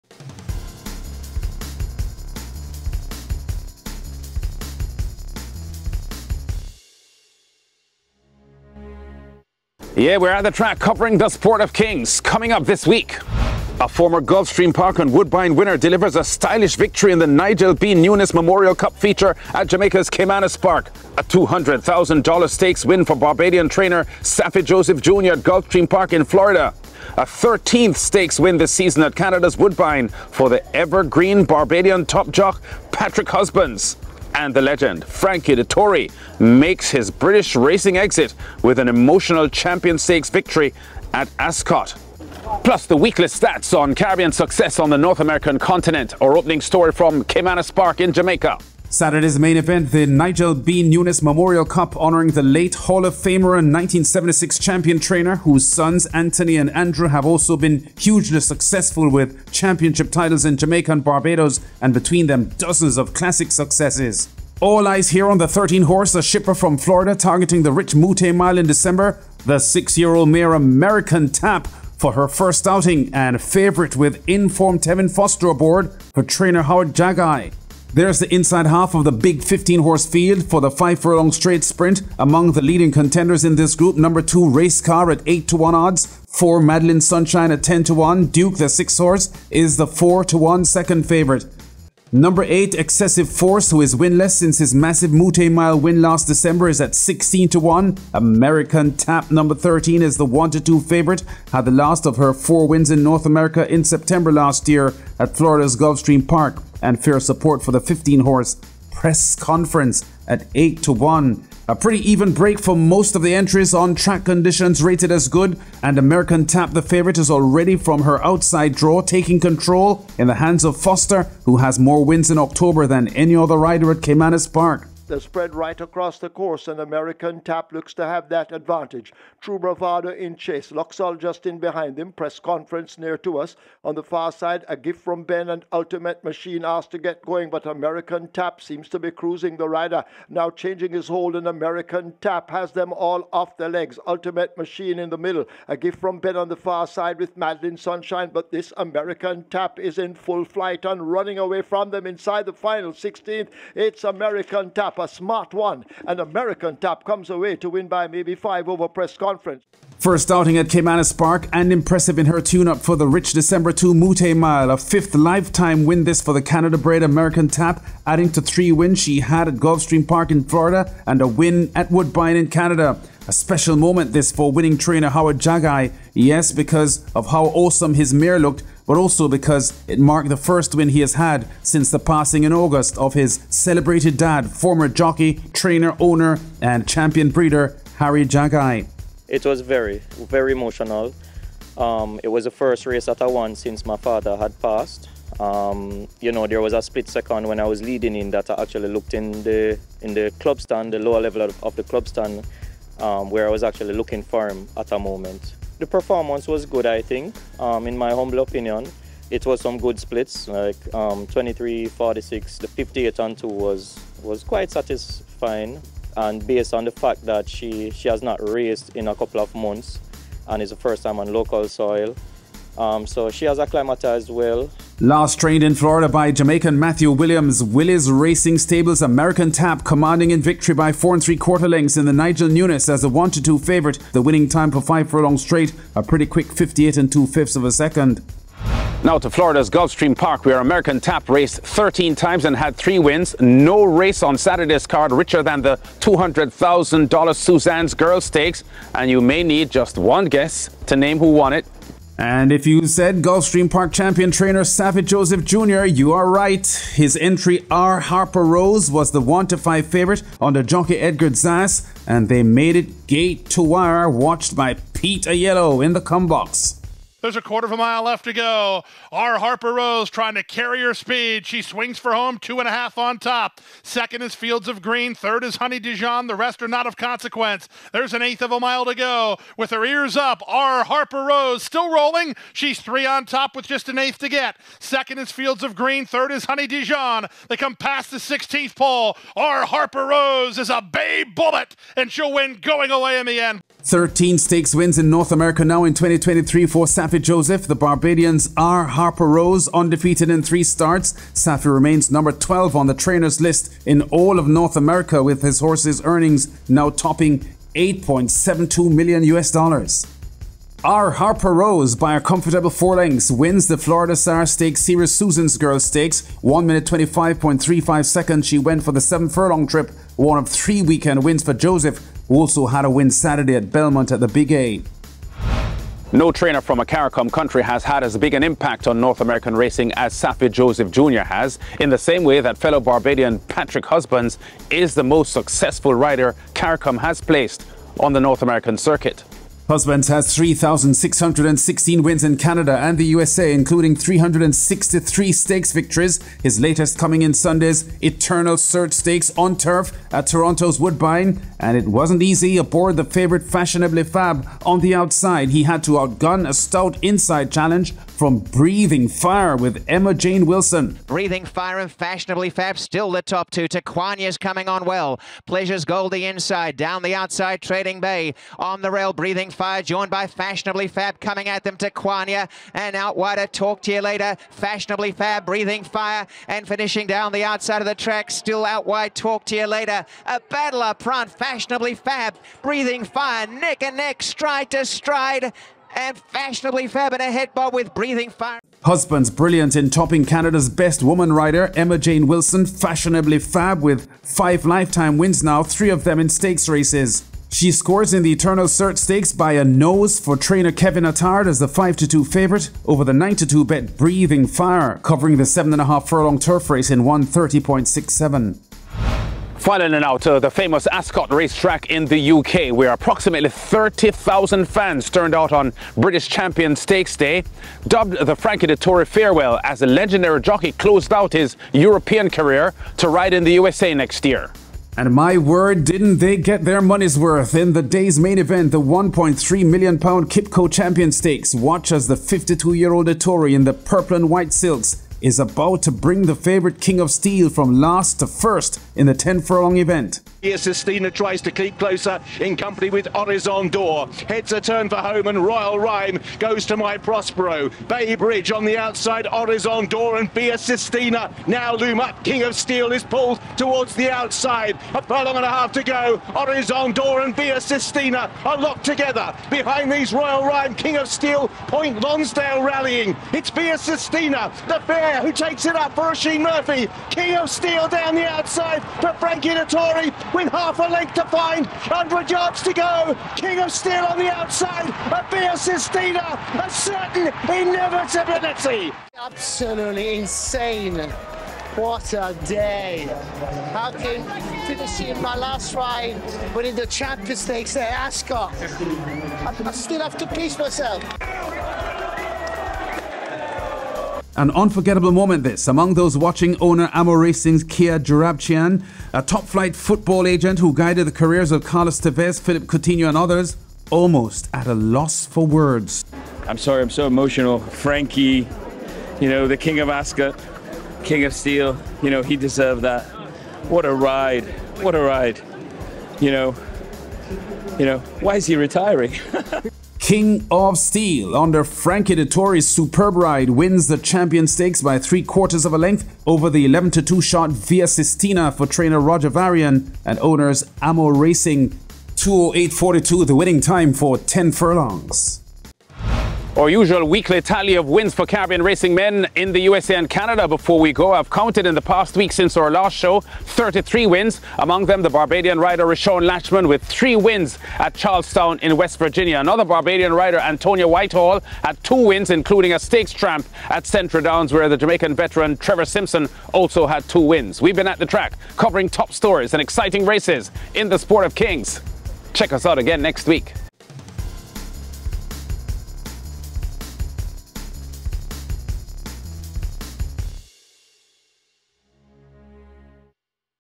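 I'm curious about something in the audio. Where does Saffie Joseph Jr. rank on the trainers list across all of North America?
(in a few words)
12.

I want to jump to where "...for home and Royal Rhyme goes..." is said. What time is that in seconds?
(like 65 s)
444 s.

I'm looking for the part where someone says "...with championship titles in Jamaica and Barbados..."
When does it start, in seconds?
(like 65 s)
59 s.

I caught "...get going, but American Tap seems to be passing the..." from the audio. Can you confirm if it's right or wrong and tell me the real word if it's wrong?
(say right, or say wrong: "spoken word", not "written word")
wrong: "cruising", not "passing".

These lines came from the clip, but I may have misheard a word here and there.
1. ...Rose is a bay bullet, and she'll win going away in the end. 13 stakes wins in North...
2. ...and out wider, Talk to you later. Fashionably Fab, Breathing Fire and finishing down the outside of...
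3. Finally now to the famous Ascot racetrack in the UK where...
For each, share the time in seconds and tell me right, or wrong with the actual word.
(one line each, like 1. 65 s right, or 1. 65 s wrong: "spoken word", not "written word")
1. 290 s right
2. 372 s right
3. 409 s right.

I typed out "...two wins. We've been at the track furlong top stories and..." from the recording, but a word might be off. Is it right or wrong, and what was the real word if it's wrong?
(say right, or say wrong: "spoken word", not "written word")
wrong: "covering", not "furlong".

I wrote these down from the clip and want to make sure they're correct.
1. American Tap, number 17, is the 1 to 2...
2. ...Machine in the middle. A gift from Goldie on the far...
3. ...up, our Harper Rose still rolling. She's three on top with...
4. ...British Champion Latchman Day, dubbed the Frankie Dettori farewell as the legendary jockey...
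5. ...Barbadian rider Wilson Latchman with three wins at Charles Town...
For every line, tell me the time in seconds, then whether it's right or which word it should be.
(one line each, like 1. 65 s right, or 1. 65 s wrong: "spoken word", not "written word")
1. 98 s wrong: "13", not "17"
2. 144 s wrong: "Ben", not "Goldie"
3. 280 s right
4. 415 s wrong: "Stakes", not "Latchman"
5. 545 s wrong: "Rashawn", not "Wilson".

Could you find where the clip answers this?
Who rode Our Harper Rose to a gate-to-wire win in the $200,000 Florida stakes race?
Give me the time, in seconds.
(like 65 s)
260 s.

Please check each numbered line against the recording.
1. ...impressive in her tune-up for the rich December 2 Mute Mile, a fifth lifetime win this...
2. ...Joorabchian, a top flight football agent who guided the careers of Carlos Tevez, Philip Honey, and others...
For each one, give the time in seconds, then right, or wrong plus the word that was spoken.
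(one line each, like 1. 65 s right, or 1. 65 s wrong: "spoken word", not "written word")
1. 161 s right
2. 497 s wrong: "Coutinho", not "Honey".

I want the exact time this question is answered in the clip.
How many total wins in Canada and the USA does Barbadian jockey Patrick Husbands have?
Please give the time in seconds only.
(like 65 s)
340 s.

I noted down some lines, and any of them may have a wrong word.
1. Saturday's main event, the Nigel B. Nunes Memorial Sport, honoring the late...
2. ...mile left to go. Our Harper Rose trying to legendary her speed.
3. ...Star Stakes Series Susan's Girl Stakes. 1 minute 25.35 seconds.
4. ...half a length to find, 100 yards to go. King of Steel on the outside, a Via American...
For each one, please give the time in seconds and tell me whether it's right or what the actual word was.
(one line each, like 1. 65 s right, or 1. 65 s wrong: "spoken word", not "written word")
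1. 48 s wrong: "Cup", not "Sport"
2. 267 s wrong: "carry", not "legendary"
3. 314 s right
4. 470 s wrong: "Sistina", not "American".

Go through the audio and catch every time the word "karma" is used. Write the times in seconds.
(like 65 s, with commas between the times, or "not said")
not said.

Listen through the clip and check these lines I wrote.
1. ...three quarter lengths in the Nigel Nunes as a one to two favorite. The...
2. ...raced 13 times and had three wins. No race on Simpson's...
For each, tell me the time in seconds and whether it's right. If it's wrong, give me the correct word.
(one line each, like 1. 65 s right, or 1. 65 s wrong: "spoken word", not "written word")
1. 231 s right
2. 241 s wrong: "Saturday", not "Simpson".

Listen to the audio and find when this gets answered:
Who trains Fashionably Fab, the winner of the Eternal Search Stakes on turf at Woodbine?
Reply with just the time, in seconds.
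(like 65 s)
400 s.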